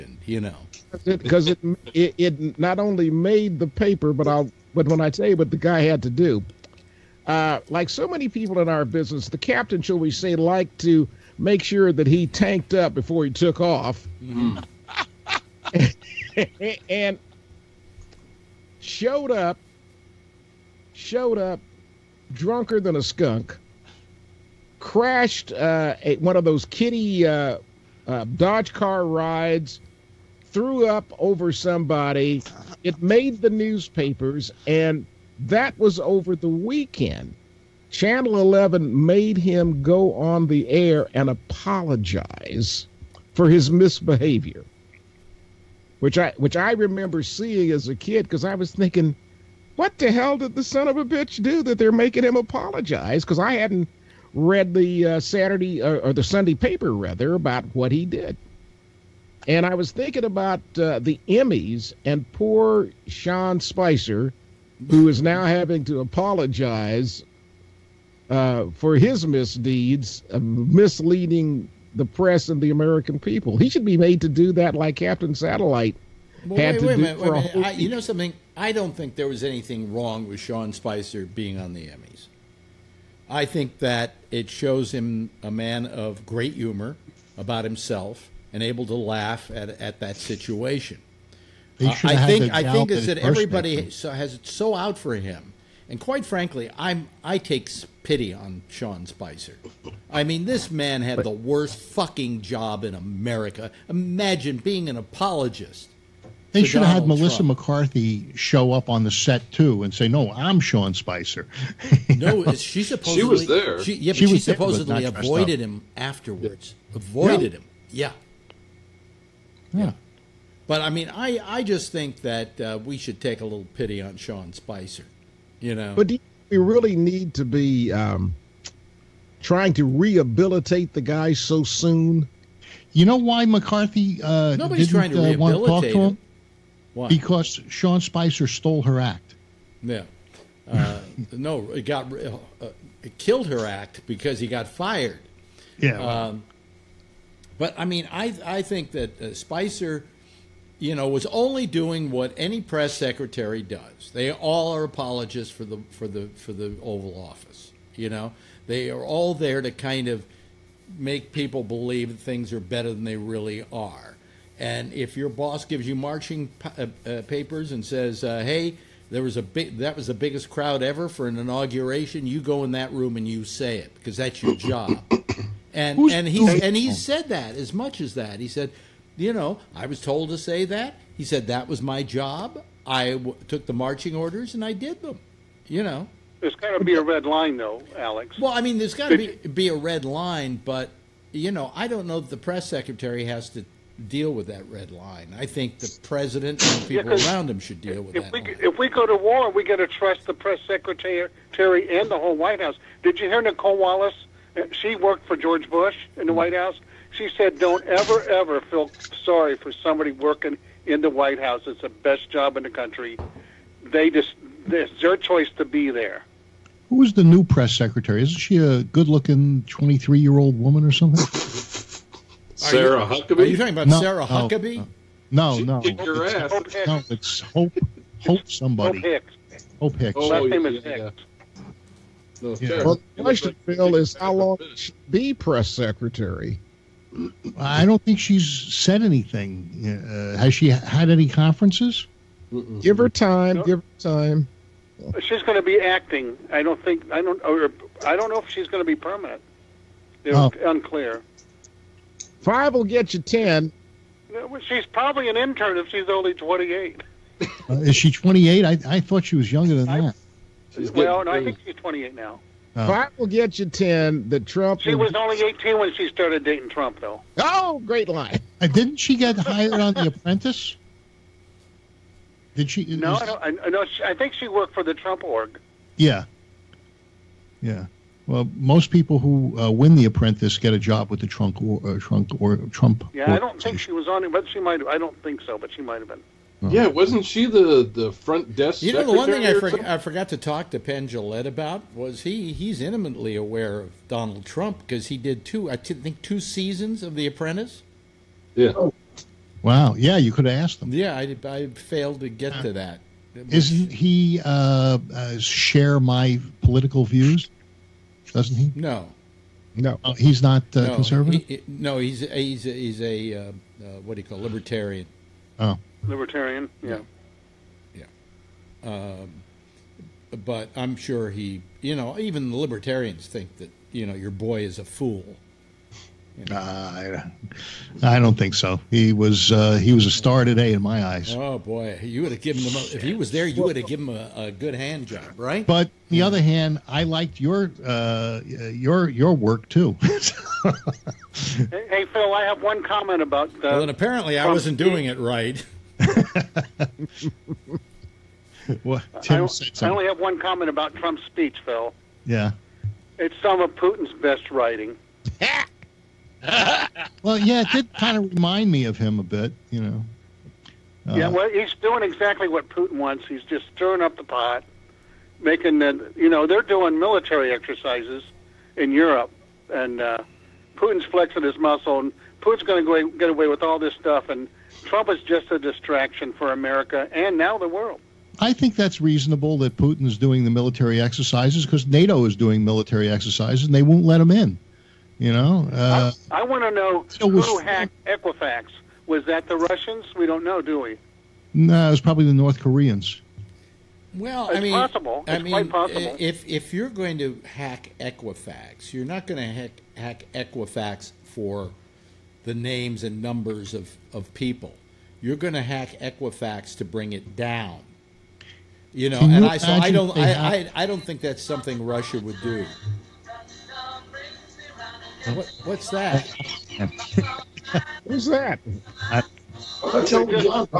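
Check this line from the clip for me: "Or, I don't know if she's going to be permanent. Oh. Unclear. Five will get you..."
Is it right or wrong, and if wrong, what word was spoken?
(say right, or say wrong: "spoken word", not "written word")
right.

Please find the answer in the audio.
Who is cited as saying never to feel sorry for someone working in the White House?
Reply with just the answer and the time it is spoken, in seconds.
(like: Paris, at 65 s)
Nicolle Wallace, at 203 s.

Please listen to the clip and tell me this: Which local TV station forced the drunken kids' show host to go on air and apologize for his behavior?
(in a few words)
Channel 11.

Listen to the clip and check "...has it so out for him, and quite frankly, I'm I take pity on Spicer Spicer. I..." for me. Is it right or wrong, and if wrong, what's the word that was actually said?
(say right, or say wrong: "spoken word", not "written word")
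wrong: "Sean", not "Spicer".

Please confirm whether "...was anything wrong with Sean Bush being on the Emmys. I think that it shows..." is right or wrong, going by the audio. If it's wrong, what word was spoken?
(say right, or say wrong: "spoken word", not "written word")
wrong: "Spicer", not "Bush".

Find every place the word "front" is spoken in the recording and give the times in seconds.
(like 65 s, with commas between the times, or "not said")
288 s.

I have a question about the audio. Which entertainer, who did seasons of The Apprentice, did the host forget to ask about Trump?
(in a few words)
Penn Jillette.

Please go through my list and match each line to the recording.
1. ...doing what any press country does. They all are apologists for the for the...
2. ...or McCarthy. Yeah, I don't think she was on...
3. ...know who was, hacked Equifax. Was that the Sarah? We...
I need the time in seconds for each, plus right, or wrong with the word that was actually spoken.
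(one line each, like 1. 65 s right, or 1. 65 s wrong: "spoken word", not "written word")
1. 151 s wrong: "secretary", not "country"
2. 282 s wrong: "Trump", not "McCarthy"
3. 386 s wrong: "Russians", not "Sarah".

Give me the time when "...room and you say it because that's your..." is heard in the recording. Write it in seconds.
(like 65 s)
172 s.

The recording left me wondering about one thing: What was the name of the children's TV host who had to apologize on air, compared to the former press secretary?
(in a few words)
Captain Satellite.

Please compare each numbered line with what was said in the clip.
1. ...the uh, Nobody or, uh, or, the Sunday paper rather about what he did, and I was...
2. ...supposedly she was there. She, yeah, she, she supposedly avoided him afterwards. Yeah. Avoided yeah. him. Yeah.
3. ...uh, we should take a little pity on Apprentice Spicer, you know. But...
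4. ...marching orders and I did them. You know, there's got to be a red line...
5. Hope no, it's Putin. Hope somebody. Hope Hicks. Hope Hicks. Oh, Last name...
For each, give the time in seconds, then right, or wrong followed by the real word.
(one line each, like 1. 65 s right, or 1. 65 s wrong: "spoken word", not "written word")
1. 54 s wrong: "Saturday", not "Nobody"
2. 112 s right
3. 122 s wrong: "Sean", not "Apprentice"
4. 183 s right
5. 226 s wrong: "Hope", not "Putin".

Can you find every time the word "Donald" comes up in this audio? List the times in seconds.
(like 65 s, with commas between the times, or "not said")
106 s, 294 s.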